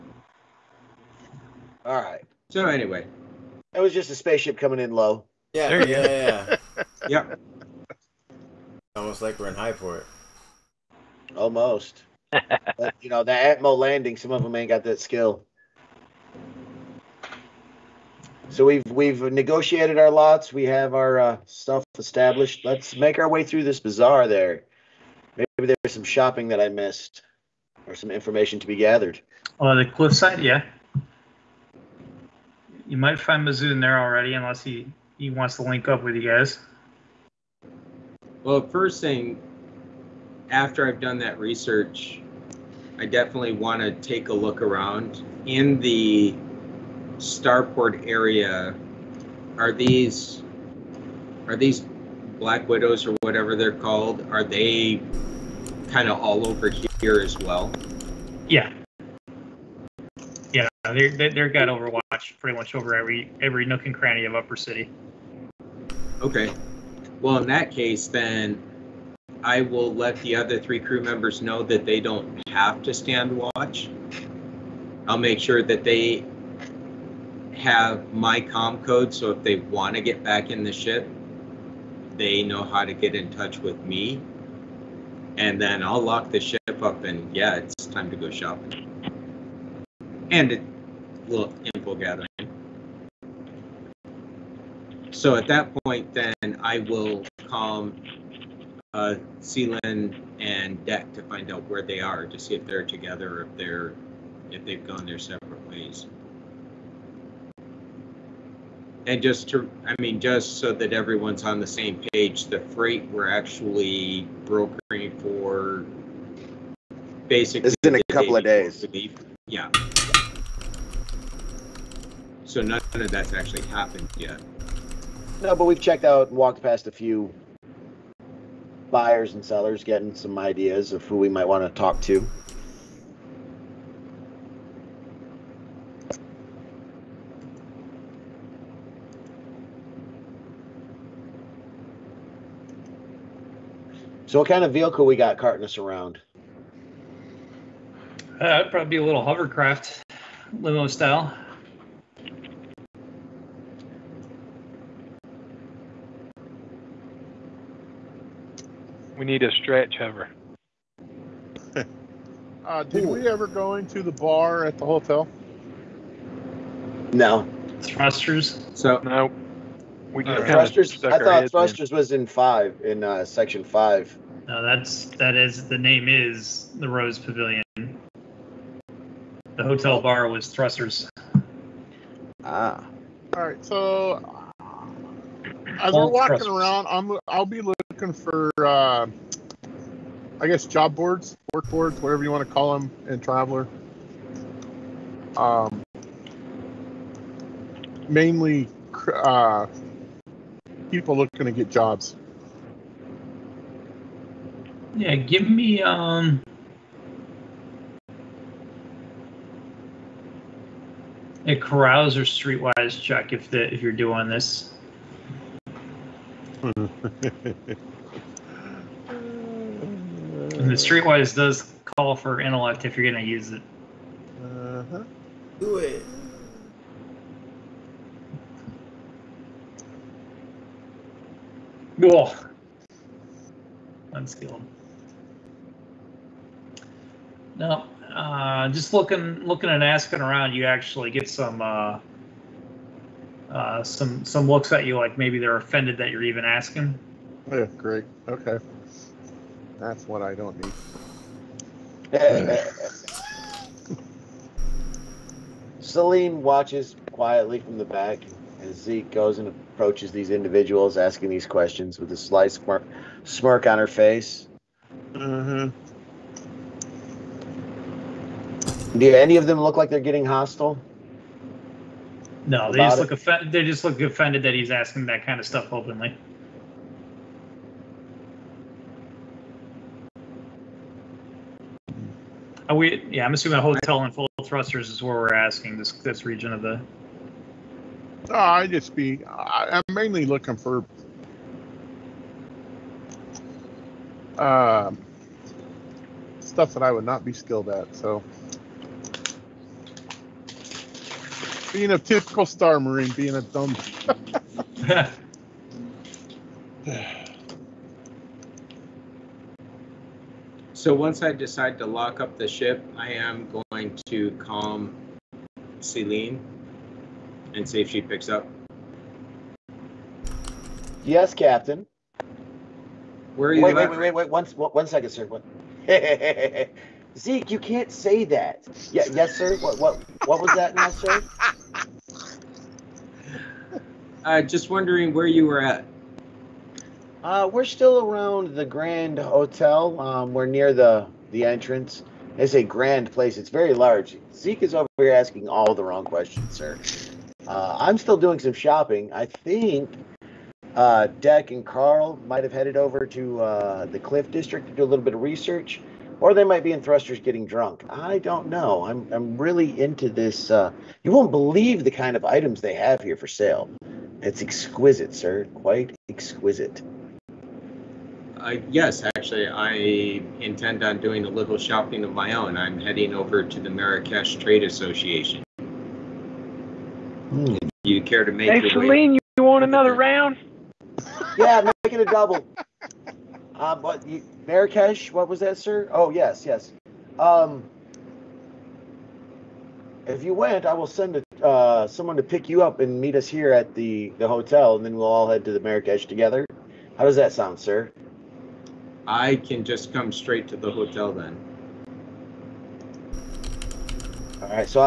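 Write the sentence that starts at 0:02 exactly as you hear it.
So anyway, that was just a spaceship coming in low.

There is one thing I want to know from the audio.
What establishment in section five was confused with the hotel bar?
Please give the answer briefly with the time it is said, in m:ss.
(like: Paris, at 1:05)
Rose Pavilion, at 2:56.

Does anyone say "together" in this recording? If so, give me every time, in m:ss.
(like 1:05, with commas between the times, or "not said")
1:42, 6:36.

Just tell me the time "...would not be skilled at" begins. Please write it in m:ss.
4:56.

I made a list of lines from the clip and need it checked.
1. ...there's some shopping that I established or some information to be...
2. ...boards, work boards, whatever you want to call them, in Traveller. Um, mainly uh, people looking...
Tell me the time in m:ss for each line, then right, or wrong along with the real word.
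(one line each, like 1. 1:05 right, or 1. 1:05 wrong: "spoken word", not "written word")
1. 0:25 wrong: "missed", not "established"
2. 3:10 right.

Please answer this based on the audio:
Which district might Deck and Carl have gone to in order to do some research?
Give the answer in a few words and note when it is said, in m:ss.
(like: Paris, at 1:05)
Cliff District, at 5:53.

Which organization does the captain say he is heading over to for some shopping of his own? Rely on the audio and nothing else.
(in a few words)
Marrakesh Trade Association.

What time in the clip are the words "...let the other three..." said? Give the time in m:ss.
1:09.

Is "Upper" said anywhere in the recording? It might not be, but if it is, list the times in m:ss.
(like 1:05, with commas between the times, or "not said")
1:04.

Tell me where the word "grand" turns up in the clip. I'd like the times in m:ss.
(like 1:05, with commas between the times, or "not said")
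5:38, 5:42.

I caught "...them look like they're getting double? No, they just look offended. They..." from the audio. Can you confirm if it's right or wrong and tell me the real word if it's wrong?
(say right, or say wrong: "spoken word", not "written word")
wrong: "hostile", not "double".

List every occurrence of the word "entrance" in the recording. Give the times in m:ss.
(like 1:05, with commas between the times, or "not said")
5:41.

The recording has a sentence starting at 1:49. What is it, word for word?
And just to, I mean, just so that everyone's on the same page, the freight we're actually brokering for basically.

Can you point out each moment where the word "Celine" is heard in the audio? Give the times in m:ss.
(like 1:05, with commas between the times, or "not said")
1:39, 4:15, 5:15, 6:18.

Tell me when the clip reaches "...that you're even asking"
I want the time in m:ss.
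4:05.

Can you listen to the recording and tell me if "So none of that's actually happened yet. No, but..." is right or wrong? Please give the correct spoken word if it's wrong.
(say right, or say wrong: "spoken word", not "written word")
right.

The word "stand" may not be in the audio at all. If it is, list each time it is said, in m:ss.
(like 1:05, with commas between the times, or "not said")
1:12.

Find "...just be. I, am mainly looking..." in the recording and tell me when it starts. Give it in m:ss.
4:48.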